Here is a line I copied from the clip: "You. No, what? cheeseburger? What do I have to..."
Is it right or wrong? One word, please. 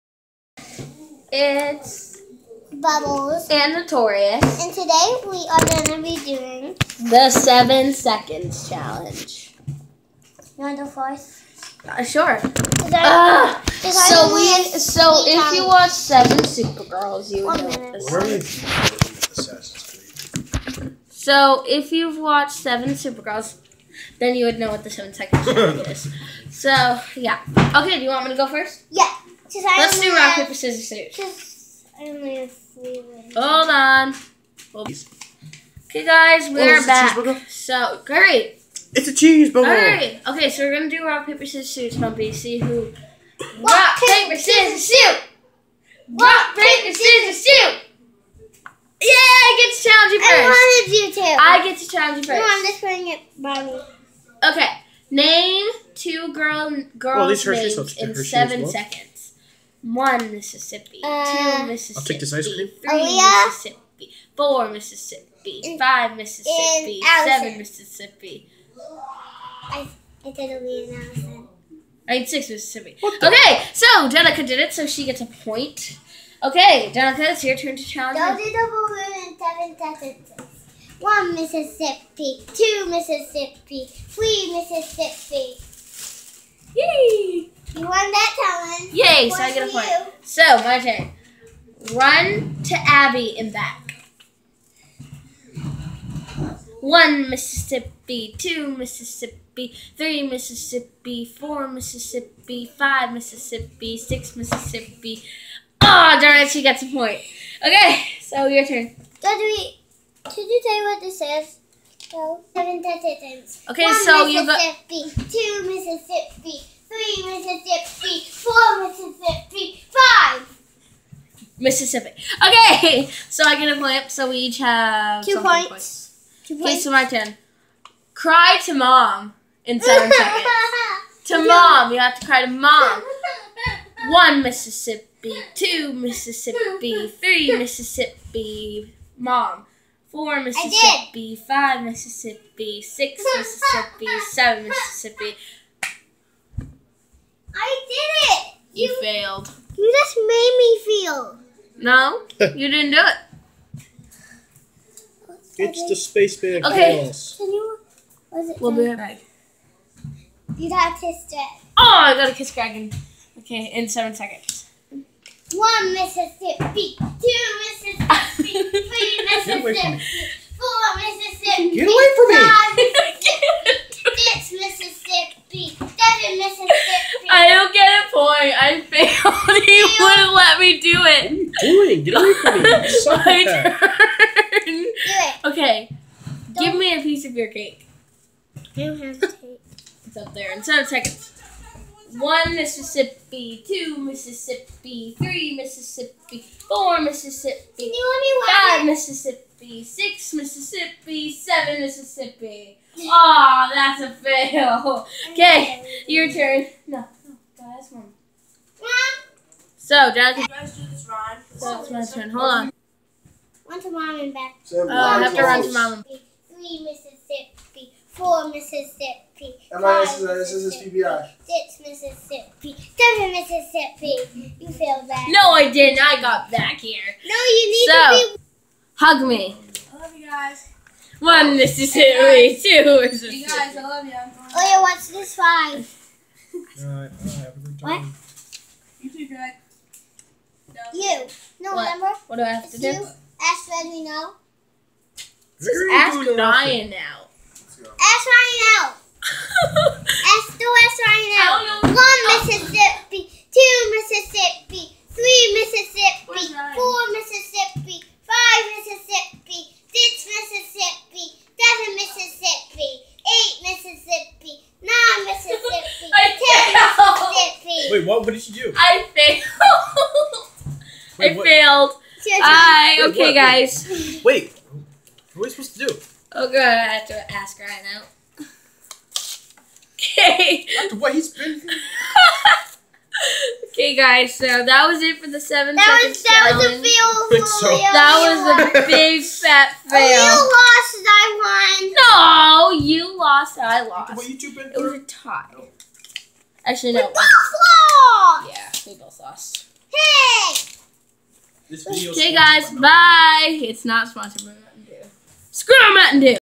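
wrong.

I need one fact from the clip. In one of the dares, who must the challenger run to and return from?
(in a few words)
Abby.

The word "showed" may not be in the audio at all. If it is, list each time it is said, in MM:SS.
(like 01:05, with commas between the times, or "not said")
not said.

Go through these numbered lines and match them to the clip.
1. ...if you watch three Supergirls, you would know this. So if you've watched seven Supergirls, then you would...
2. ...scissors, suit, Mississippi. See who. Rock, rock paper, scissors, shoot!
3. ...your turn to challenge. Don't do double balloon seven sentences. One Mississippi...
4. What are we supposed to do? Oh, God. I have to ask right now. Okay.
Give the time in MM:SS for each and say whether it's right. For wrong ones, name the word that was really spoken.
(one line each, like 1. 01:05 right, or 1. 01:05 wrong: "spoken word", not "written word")
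1. 00:15 wrong: "seven", not "three"
2. 00:41 wrong: "Pumpy", not "Mississippi"
3. 01:17 right
4. 04:35 right.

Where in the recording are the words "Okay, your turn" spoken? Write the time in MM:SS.
03:25.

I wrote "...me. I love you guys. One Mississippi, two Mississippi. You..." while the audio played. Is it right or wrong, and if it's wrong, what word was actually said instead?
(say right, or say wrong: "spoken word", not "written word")
right.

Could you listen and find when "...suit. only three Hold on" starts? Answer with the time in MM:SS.
00:30.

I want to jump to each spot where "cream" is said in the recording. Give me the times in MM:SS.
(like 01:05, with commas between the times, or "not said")
01:02.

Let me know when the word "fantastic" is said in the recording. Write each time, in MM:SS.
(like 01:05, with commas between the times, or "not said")
not said.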